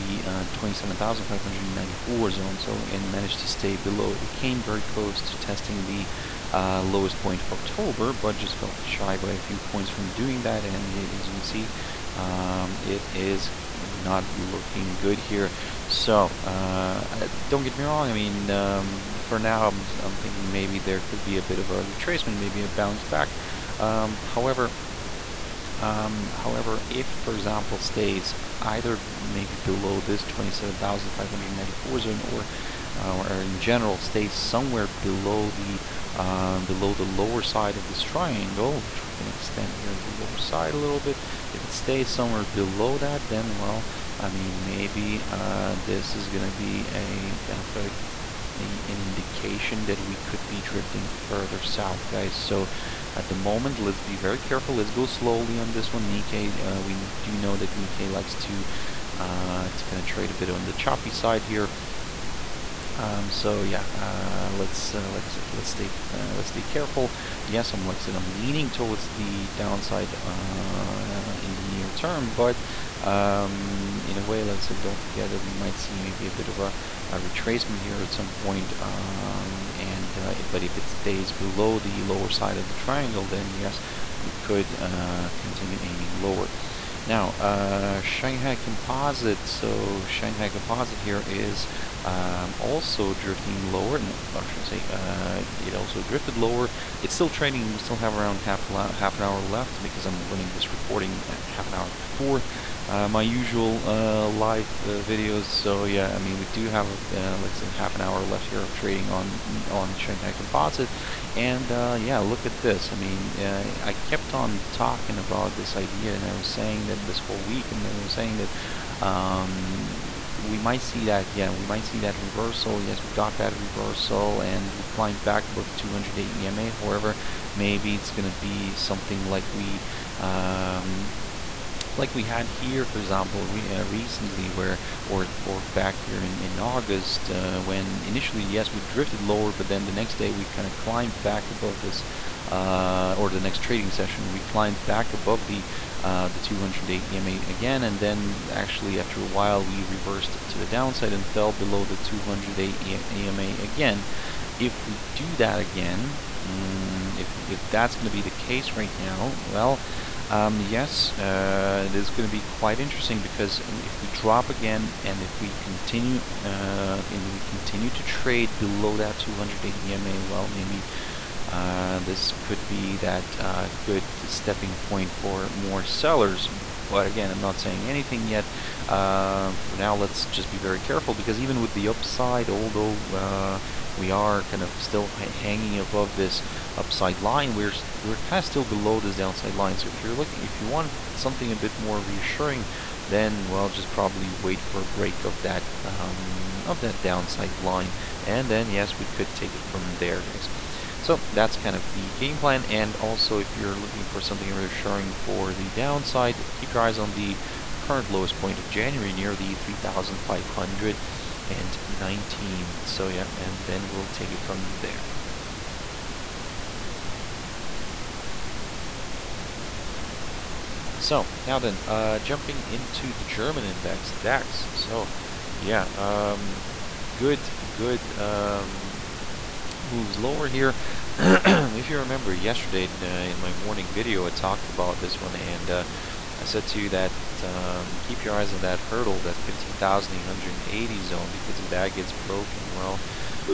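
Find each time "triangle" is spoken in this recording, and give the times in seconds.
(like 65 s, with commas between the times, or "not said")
38 s, 82 s.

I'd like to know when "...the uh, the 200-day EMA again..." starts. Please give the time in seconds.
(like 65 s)
145 s.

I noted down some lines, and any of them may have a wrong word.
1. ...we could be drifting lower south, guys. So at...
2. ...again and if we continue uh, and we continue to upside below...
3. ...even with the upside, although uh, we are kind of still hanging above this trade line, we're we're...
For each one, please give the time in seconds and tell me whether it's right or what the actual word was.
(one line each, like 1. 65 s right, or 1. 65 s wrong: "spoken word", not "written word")
1. 50 s wrong: "further", not "lower"
2. 164 s wrong: "trade", not "upside"
3. 181 s wrong: "upside", not "trade".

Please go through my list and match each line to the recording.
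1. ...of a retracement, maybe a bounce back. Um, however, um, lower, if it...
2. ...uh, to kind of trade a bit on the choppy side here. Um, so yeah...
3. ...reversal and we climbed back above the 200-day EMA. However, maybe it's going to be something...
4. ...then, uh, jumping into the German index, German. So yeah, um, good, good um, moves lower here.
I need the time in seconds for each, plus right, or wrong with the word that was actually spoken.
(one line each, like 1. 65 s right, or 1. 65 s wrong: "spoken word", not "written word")
1. 21 s wrong: "however", not "lower"
2. 59 s right
3. 123 s right
4. 221 s wrong: "DAX", not "German".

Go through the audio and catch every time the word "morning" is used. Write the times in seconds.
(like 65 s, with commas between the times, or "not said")
233 s.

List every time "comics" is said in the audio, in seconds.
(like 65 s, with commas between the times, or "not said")
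not said.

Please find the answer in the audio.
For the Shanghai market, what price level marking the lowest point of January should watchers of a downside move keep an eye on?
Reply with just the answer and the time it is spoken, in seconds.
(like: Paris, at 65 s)
3,519, at 209 s.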